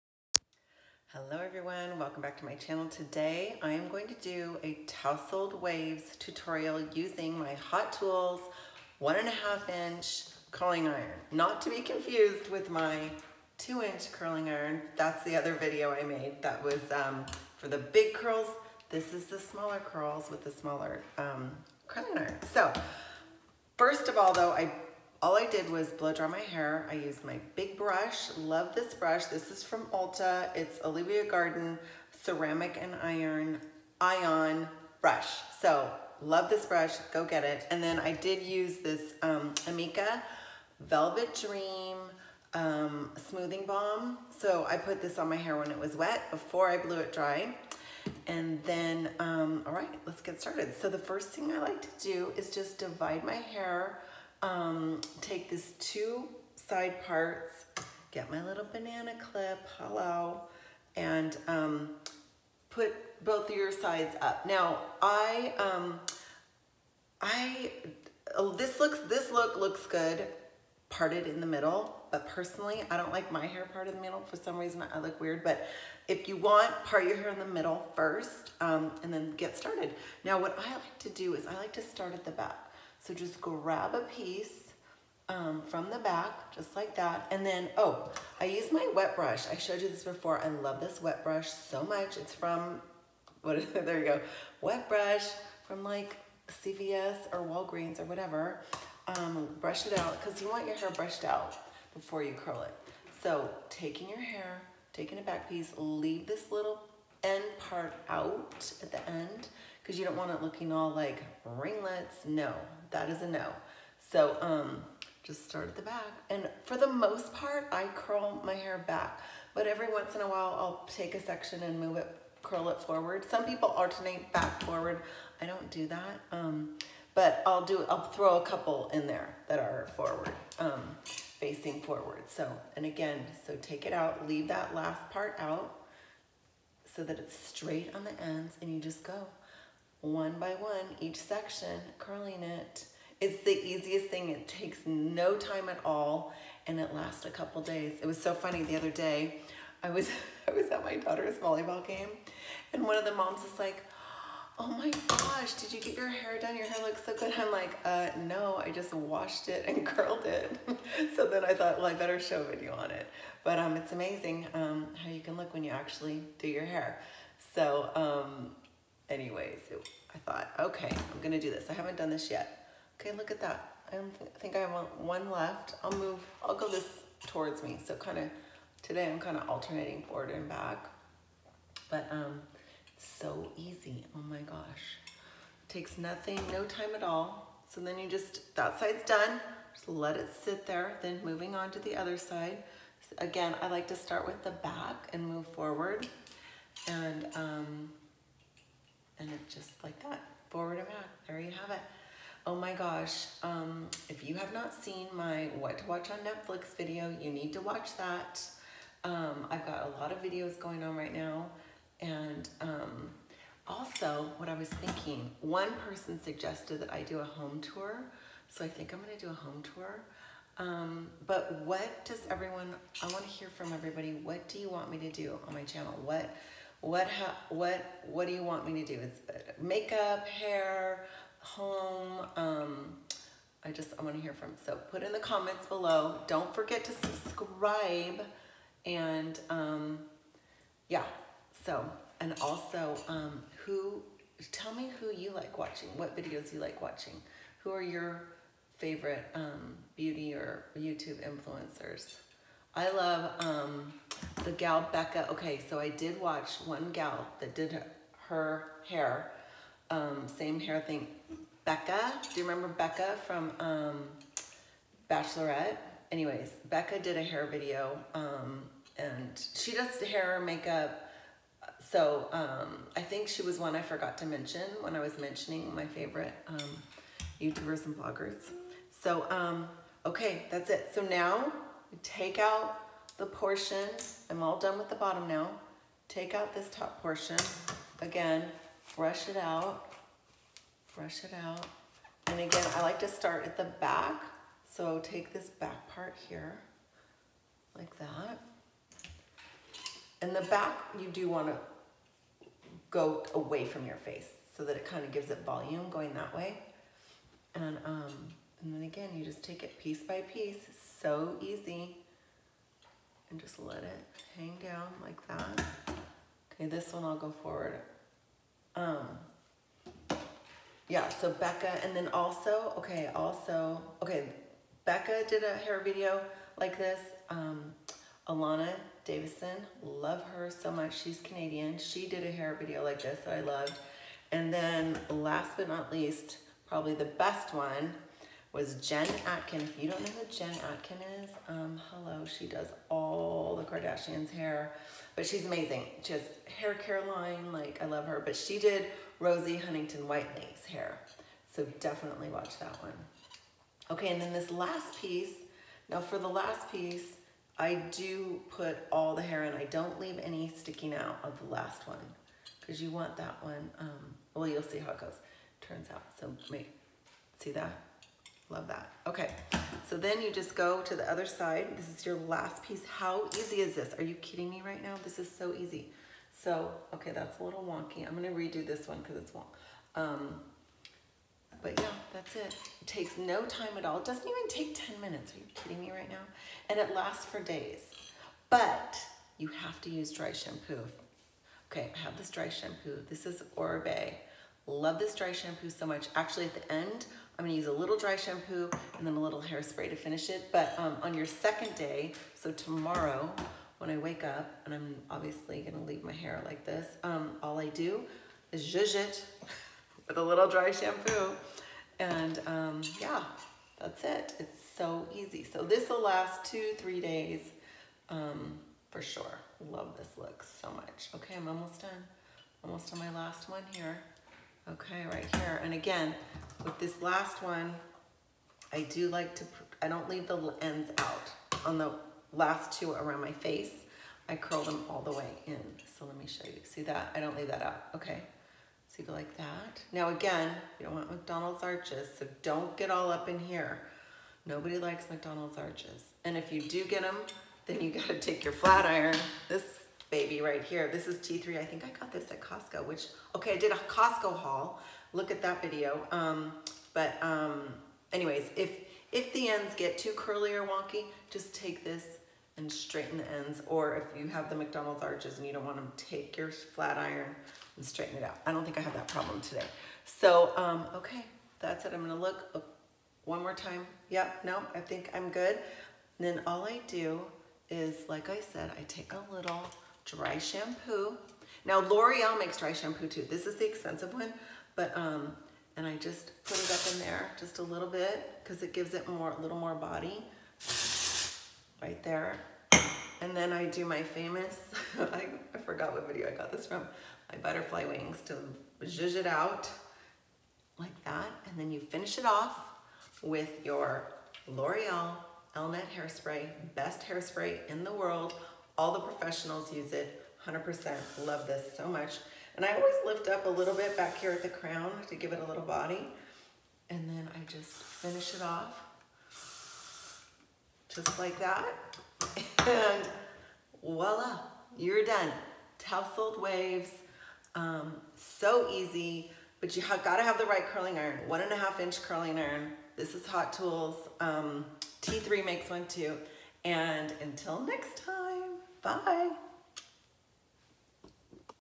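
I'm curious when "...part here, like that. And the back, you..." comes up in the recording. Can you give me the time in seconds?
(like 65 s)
295 s.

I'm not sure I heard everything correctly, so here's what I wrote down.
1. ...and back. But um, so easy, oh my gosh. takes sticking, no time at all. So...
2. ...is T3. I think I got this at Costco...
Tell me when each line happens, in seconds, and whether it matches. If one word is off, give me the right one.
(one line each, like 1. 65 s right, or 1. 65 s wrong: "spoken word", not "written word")
1. 180 s wrong: "nothing", not "sticking"
2. 451 s right.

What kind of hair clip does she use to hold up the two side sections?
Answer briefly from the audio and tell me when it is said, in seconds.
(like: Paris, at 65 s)
banana clip, at 58 s.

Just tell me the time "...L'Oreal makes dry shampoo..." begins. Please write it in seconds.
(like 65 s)
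481 s.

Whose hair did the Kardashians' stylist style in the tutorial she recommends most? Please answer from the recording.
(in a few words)
Rosie Huntington Whiteley.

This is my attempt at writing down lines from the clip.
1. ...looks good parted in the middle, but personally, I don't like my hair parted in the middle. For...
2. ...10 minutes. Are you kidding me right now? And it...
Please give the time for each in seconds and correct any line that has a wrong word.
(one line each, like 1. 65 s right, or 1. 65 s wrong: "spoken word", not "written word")
1. 69 s right
2. 384 s right.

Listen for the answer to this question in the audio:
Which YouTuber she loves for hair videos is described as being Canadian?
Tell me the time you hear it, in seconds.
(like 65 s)
328 s.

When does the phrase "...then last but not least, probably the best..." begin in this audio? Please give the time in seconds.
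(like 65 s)
334 s.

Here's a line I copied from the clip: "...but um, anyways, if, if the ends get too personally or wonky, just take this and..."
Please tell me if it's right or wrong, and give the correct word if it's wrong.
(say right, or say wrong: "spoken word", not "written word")
wrong: "curly", not "personally".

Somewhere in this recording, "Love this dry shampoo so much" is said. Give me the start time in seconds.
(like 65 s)
394 s.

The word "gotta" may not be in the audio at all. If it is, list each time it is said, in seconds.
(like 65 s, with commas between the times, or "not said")
447 s, 530 s.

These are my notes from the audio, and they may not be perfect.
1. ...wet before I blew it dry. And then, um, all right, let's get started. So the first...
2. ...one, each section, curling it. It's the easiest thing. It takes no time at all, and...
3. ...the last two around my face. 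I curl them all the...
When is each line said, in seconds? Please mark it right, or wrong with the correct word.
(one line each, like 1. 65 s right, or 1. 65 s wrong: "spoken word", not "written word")
1. 45 s right
2. 140 s right
3. 431 s right.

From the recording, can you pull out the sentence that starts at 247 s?
Who are your favorite um, beauty or YouTube influencers?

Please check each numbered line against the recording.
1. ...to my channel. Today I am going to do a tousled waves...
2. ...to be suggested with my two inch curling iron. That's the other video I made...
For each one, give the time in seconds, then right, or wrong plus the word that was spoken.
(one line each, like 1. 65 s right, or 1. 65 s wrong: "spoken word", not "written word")
1. 2 s right
2. 11 s wrong: "confused", not "suggested".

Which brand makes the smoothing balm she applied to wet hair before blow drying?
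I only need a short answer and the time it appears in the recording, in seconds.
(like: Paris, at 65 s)
Amika, at 39 s.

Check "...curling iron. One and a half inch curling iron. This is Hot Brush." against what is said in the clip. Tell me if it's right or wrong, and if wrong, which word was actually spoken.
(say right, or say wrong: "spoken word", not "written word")
wrong: "Tools", not "Brush".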